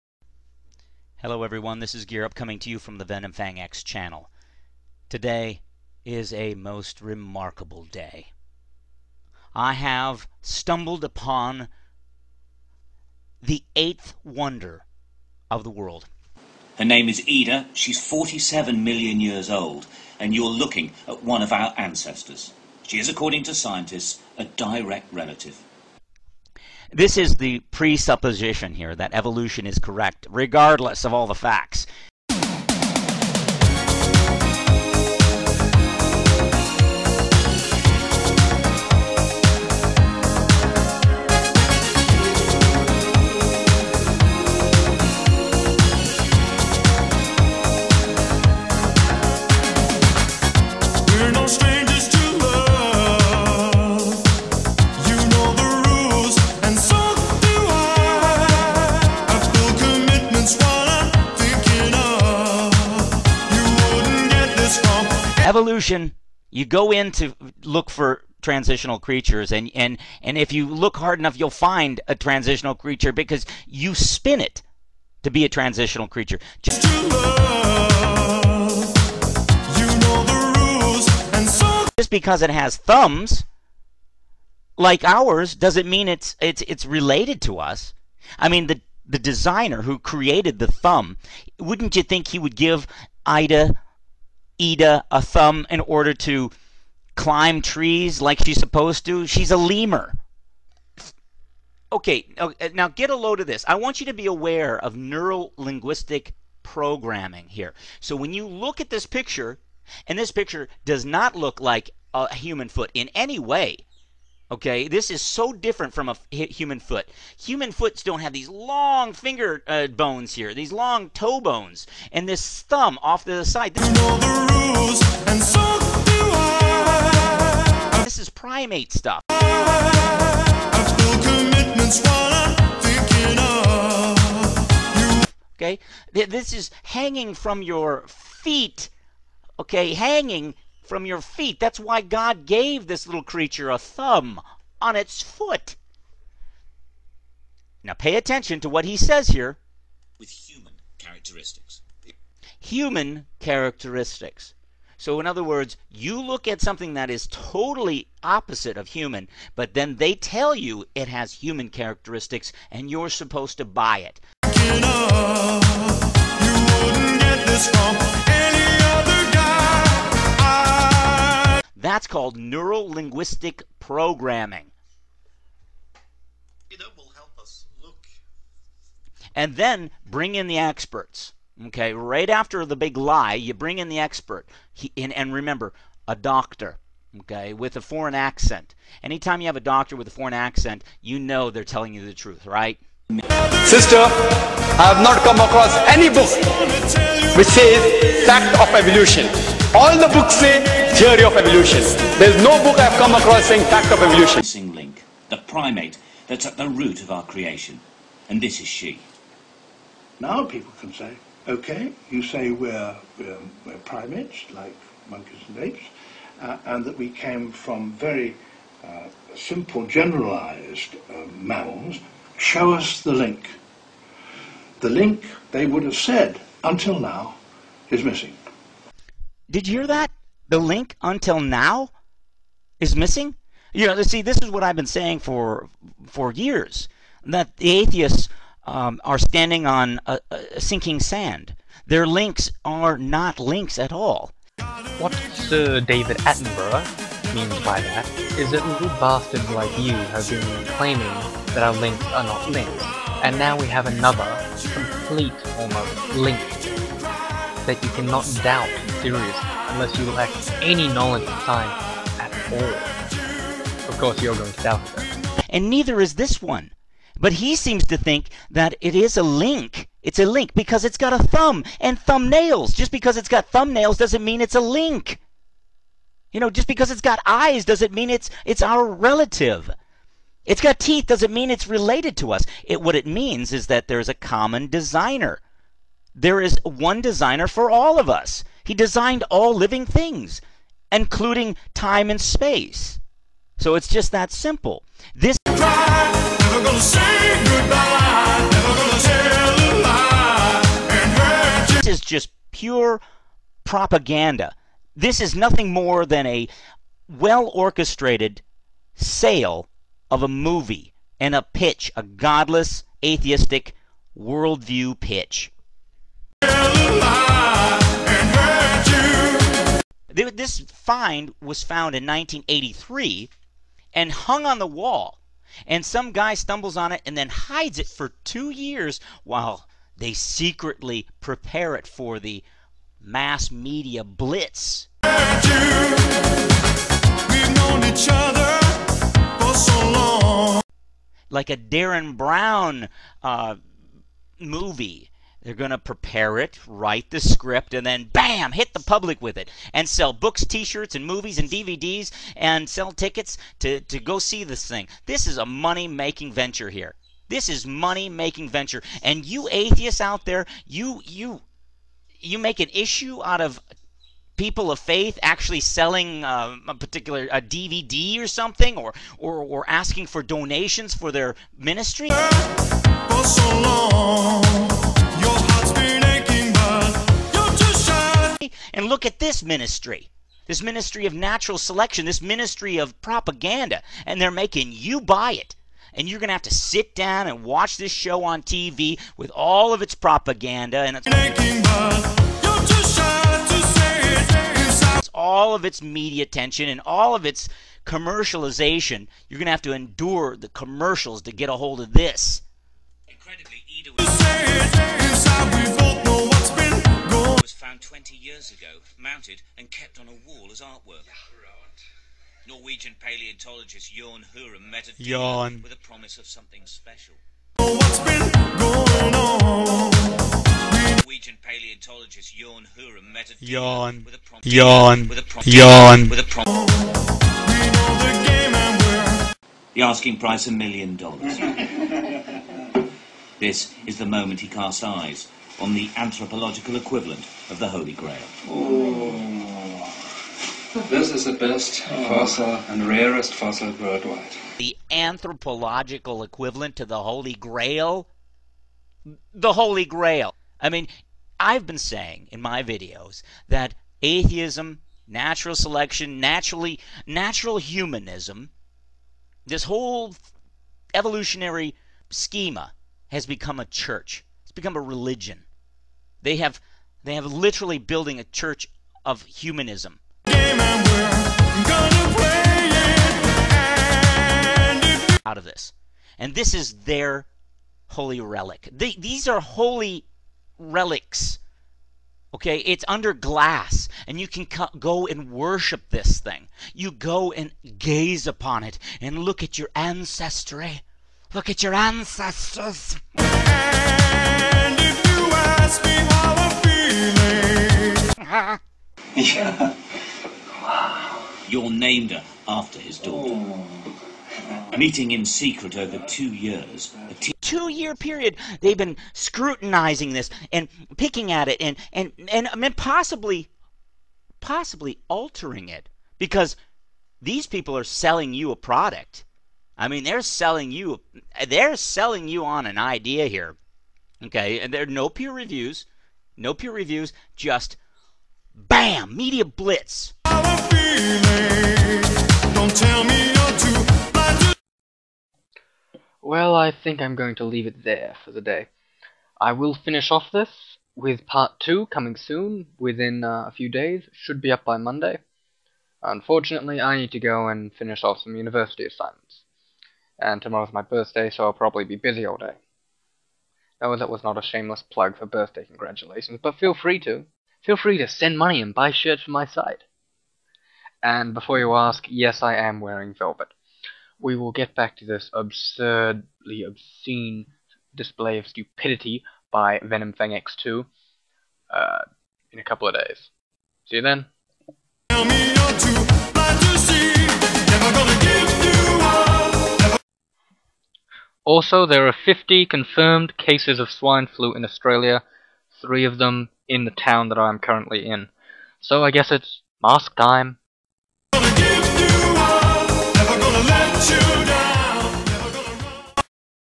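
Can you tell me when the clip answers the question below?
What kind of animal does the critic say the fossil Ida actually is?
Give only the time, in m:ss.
1:39.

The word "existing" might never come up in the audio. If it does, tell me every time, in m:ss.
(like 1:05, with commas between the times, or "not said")
not said.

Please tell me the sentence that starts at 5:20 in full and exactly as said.
this find was found in 1983 and hung on the wall.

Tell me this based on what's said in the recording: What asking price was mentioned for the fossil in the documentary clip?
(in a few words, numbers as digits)
A million dollars.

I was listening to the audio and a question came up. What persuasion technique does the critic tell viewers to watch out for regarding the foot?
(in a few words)
Neuro linguistic programming.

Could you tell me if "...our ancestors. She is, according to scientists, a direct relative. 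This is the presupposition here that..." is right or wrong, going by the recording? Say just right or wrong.
right.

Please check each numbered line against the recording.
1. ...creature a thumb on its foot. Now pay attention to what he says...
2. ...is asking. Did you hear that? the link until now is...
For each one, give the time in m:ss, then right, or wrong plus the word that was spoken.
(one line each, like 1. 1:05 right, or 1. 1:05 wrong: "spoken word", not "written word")
1. 2:23 right
2. 3:47 wrong: "missing", not "asking".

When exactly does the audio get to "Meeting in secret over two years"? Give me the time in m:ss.
8:24.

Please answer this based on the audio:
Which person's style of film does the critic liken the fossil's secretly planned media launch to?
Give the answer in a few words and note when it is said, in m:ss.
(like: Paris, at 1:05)
Darren Brown, at 5:41.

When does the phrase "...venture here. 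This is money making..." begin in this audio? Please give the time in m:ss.
5:56.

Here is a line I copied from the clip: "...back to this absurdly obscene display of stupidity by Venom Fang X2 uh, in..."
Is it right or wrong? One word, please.
right.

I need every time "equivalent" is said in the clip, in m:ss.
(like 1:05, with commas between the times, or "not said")
7:16, 7:26.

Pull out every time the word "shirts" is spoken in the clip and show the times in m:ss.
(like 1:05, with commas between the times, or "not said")
5:50, 9:18.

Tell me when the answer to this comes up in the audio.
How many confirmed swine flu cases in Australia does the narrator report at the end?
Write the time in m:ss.
9:42.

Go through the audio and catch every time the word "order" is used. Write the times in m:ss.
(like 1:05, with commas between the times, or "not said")
1:35.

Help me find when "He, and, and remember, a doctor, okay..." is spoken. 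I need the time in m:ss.
3:04.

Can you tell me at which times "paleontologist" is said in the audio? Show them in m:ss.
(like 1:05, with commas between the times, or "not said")
6:52, 7:01.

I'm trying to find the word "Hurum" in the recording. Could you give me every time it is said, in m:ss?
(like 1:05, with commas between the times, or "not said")
6:54, 7:02.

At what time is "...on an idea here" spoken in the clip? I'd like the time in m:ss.
8:42.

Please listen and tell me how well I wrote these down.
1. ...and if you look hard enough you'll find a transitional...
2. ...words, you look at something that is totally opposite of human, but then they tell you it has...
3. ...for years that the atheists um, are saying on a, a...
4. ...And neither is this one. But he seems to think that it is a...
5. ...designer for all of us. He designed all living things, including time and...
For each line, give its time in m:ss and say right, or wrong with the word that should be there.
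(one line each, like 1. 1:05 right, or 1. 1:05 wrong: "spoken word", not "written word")
1. 1:10 right
2. 2:35 right
3. 3:56 wrong: "standing", not "saying"
4. 4:25 right
5. 4:47 right.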